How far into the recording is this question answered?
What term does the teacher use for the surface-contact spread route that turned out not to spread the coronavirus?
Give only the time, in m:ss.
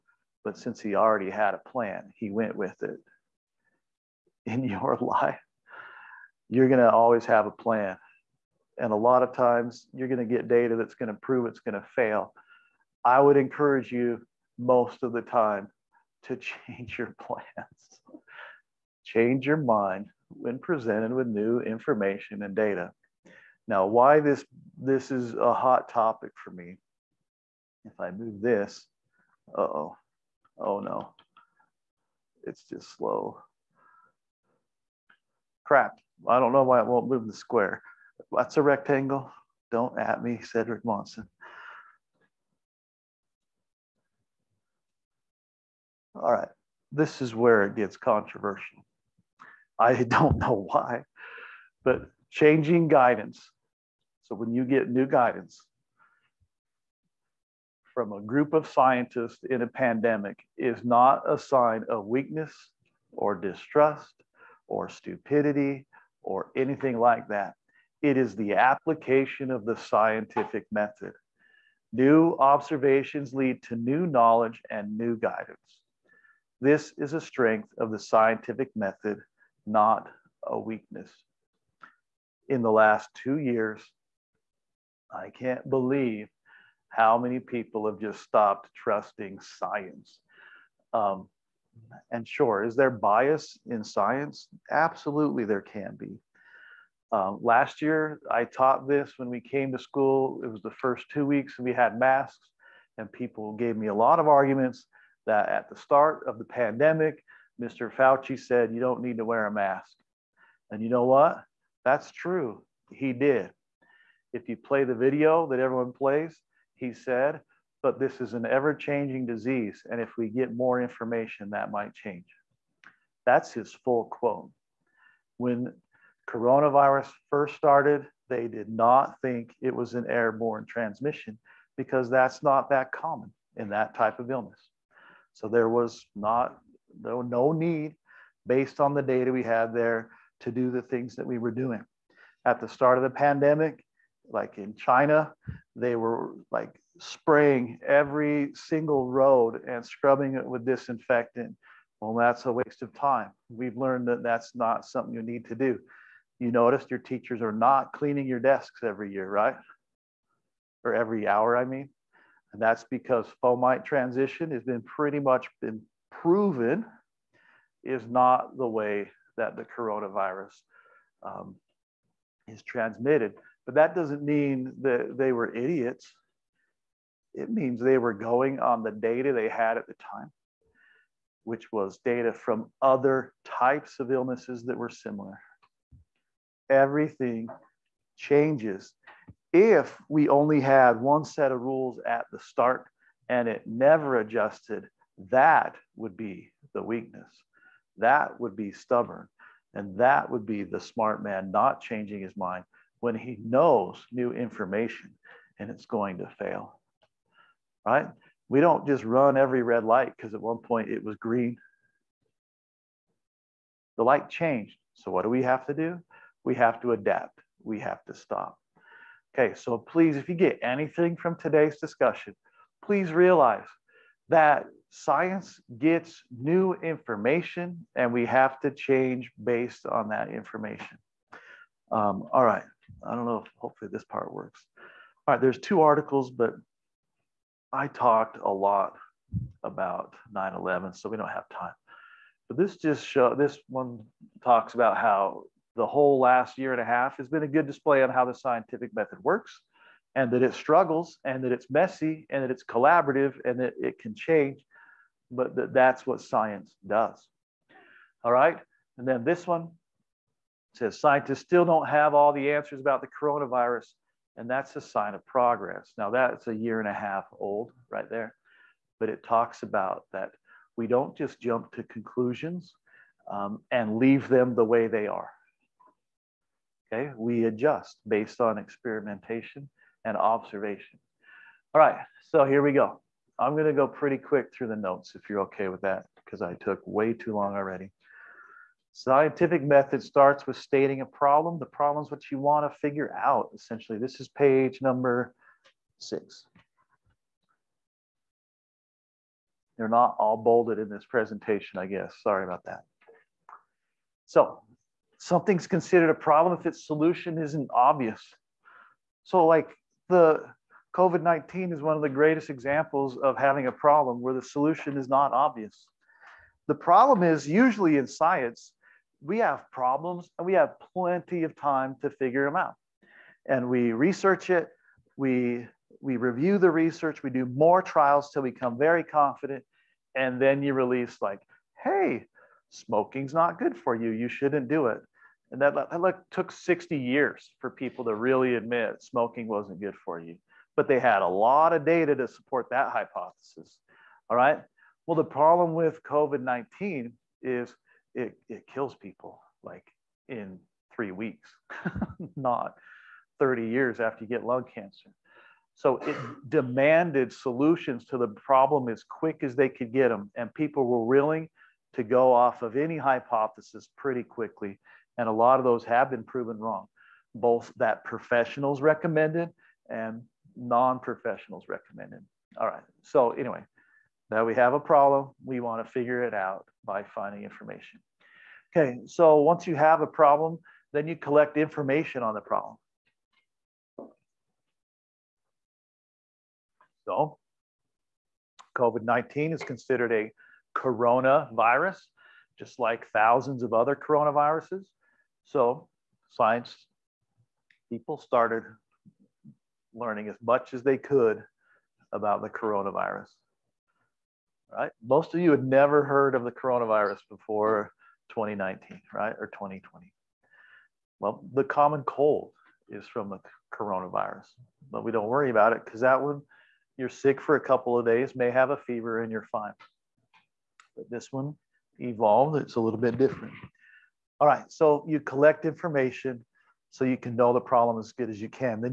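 2:43.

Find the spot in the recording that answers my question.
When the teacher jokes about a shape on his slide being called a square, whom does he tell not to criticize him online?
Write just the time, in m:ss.
0:40.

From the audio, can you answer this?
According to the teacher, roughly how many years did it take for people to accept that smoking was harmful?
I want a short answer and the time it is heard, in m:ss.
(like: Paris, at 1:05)
60 years, at 5:36.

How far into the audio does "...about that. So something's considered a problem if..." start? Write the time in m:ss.
5:02.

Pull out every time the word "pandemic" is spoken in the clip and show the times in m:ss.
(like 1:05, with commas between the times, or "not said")
0:59, 1:46, 2:23.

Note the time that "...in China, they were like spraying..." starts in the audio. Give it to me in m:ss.
2:24.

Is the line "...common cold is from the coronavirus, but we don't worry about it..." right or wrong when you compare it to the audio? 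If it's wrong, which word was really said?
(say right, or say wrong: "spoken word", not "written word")
right.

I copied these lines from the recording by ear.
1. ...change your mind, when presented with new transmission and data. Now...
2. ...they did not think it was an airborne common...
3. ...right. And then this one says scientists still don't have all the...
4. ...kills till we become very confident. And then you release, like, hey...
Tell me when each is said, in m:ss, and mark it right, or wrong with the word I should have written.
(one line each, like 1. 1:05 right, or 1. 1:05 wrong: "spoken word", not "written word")
1. 0:19 wrong: "information", not "transmission"
2. 2:08 wrong: "transmission", not "common"
3. 4:18 right
4. 5:27 wrong: "trials", not "kills".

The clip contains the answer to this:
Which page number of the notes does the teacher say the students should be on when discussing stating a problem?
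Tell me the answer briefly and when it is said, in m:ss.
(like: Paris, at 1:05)
page number six, at 4:54.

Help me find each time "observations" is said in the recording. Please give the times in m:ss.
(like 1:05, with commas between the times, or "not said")
1:12, 4:40.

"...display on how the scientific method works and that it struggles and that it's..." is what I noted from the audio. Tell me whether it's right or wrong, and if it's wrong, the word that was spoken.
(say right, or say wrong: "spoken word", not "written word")
right.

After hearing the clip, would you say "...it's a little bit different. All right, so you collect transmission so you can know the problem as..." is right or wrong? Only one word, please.
wrong.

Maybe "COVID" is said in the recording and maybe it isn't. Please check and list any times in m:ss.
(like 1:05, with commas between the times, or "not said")
5:10, 5:46, 6:28.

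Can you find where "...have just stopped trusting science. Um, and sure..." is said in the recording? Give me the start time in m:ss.
1:27.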